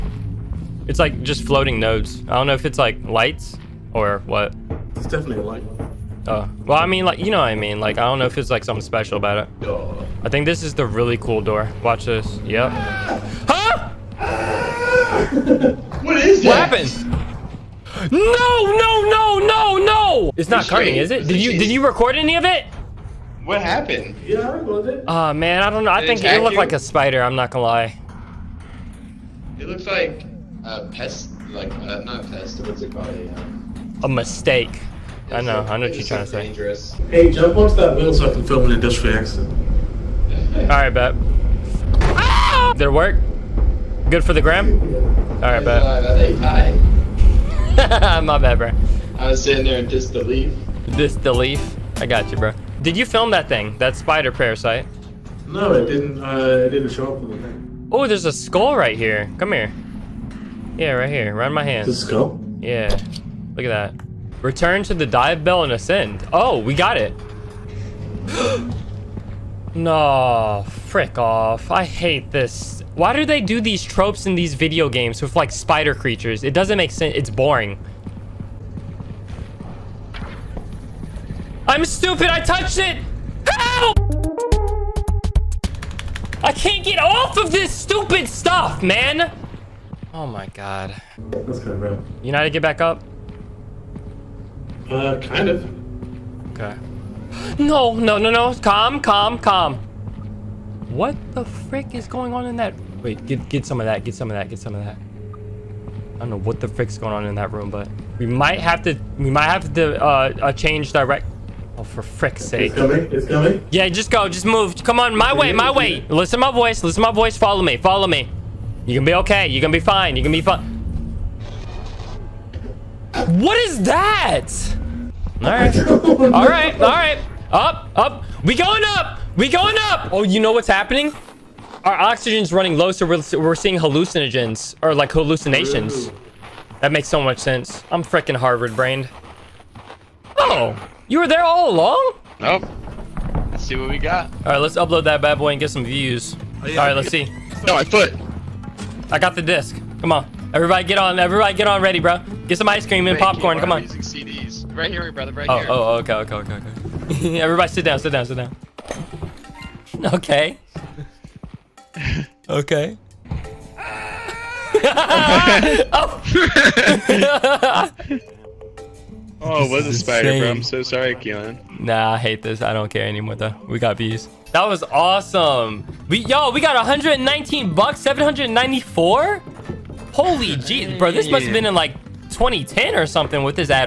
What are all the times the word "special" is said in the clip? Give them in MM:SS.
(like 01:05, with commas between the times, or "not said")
00:08.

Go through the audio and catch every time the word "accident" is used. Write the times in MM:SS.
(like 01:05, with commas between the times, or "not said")
00:39.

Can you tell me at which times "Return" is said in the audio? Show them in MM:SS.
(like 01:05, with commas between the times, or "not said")
01:04.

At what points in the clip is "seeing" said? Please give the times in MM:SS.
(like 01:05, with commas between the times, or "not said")
02:13.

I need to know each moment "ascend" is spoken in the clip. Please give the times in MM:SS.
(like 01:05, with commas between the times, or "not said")
01:05.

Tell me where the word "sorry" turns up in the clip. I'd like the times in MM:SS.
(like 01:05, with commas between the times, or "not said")
02:50.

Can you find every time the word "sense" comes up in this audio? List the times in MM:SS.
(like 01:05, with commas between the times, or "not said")
01:16, 02:17.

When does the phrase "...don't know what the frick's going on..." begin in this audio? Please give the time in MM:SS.
01:46.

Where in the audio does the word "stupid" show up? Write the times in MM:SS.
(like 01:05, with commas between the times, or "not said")
01:21, 01:27.